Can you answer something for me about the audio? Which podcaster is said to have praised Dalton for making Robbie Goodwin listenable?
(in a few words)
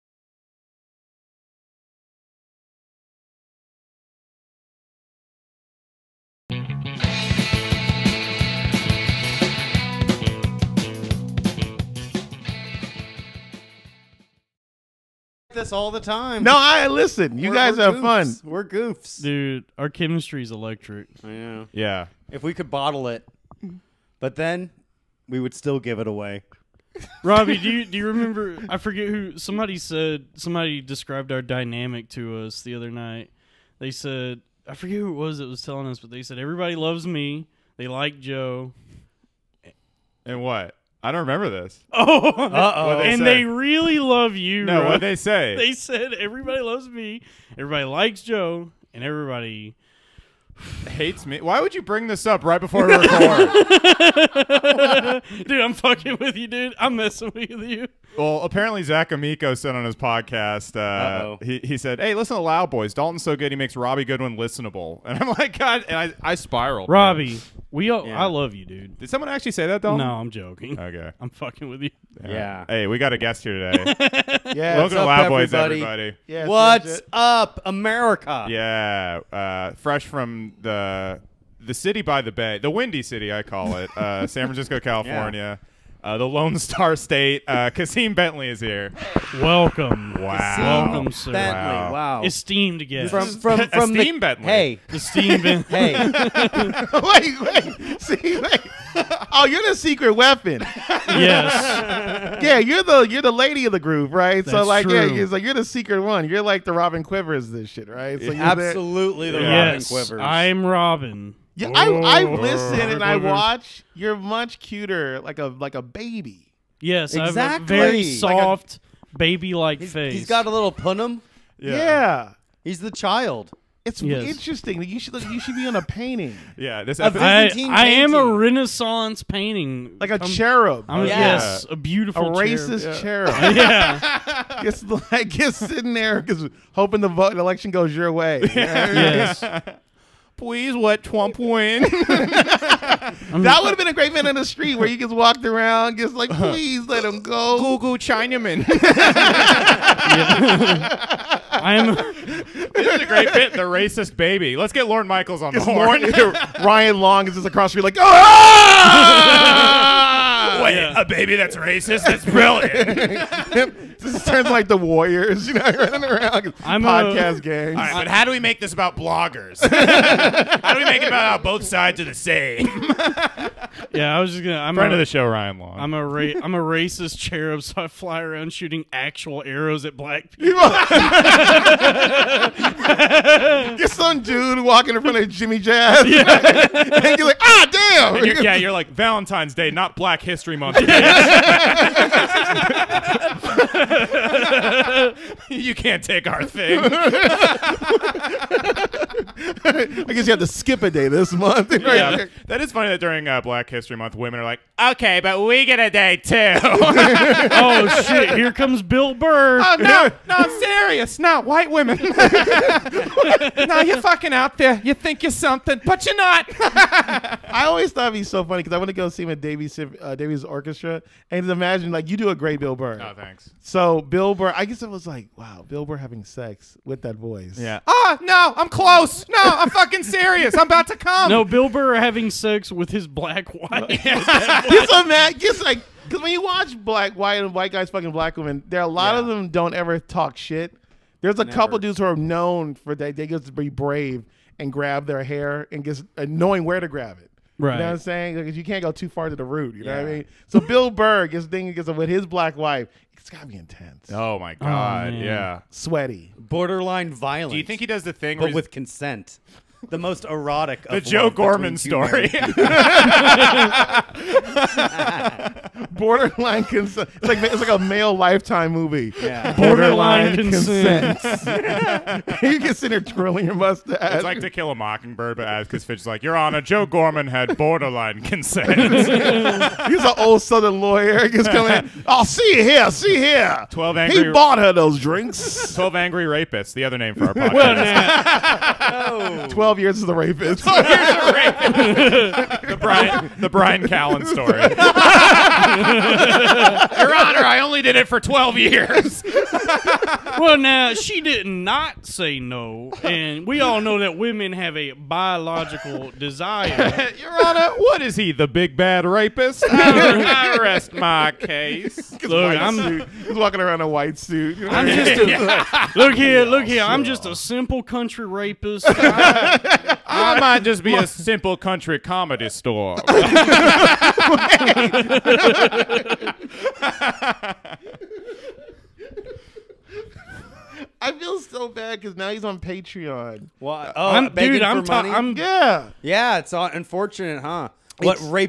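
Zach Amico.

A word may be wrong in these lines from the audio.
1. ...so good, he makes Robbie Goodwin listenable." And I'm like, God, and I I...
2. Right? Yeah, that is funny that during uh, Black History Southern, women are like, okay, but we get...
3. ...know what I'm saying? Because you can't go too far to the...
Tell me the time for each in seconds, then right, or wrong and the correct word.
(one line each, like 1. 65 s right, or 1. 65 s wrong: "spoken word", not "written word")
1. 63 s right
2. 201 s wrong: "Month", not "Southern"
3. 247 s right.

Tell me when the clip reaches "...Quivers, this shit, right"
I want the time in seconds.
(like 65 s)
107 s.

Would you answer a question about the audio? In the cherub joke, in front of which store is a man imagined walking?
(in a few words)
Jimmy Jazz.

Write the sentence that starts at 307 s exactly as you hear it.
Your Honor, what is he, the big bad rapist?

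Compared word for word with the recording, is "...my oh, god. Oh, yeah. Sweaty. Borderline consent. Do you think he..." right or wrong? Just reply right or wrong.
wrong.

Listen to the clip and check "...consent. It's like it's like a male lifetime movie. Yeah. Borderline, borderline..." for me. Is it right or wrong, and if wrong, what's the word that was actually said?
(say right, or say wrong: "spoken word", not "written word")
right.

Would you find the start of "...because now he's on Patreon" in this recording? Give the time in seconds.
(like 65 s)
332 s.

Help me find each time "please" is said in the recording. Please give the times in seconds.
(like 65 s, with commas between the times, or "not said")
140 s, 146 s.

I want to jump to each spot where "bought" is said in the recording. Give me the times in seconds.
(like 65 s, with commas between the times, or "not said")
284 s.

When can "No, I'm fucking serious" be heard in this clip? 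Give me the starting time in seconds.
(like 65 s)
229 s.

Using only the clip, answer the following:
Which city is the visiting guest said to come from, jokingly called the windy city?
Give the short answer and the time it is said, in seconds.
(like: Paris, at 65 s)
San Francisco, at 84 s.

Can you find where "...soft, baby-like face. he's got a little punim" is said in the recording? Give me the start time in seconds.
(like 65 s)
118 s.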